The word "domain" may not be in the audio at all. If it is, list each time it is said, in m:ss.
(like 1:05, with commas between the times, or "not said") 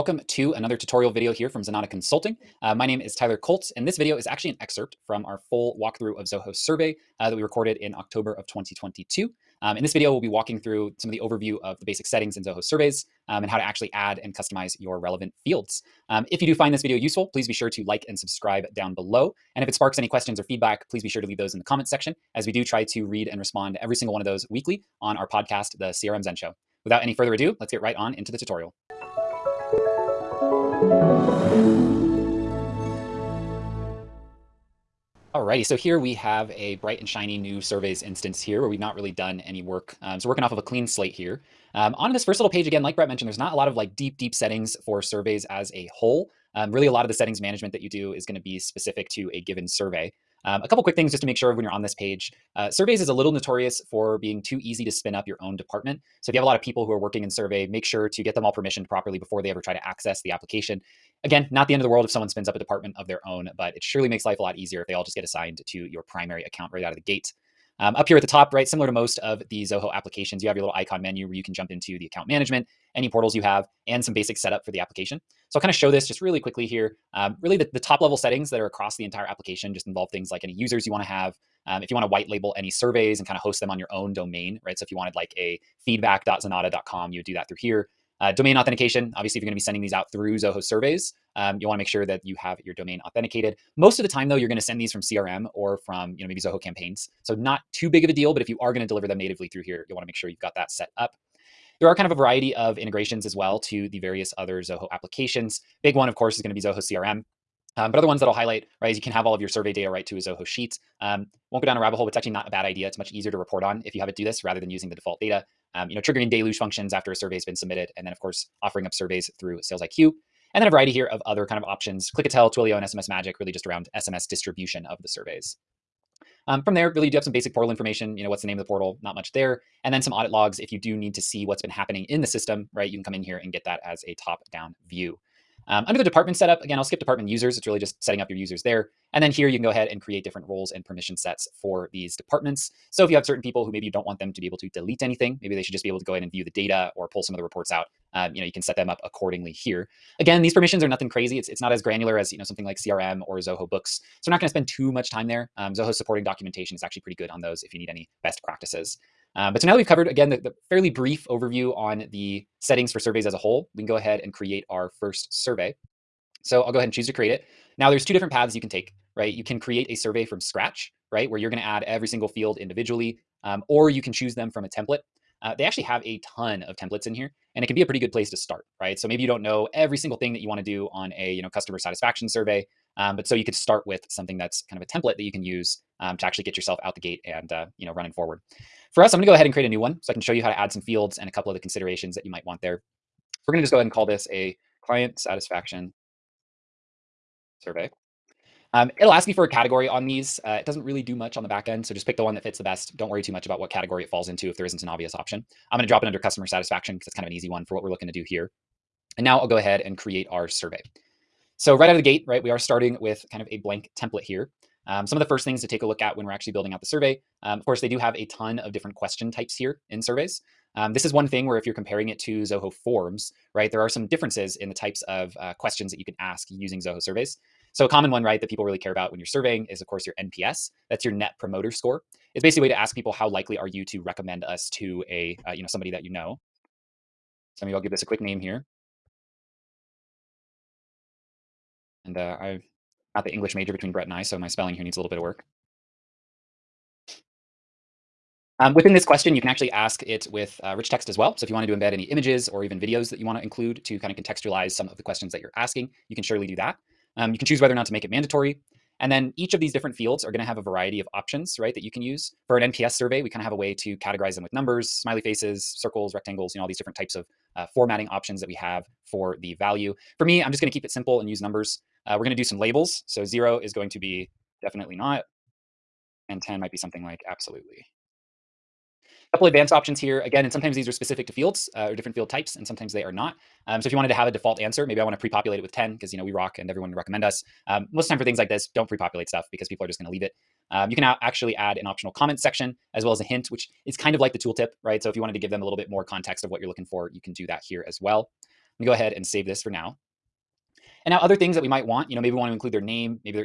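1:24, 1:28, 1:32.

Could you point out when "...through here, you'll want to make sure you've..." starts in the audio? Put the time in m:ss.
1:39.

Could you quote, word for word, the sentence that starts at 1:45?
Big one, of course, is going to be Zoho CRM.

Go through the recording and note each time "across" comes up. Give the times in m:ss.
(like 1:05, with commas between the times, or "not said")
1:18.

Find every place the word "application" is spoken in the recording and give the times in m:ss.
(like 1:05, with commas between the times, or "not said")
1:00, 1:09, 1:14, 1:19, 1:44.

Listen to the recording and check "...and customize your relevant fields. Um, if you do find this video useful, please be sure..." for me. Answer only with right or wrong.
right.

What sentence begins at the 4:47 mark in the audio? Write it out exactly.
Um, most of the time for things like this, don't pre-populate stuff because people are just going to leave it.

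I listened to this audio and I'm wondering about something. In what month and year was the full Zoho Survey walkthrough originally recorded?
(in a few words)
October 2022.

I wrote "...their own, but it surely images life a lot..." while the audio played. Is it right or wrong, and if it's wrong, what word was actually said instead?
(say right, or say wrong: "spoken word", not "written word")
wrong: "makes", not "images".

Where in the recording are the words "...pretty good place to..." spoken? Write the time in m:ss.
2:57.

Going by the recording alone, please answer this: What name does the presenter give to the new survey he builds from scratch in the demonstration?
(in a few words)
Client Satisfaction Survey.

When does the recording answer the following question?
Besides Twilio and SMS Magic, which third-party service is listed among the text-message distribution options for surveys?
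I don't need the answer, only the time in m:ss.
2:02.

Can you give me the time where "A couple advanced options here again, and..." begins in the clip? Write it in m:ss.
4:39.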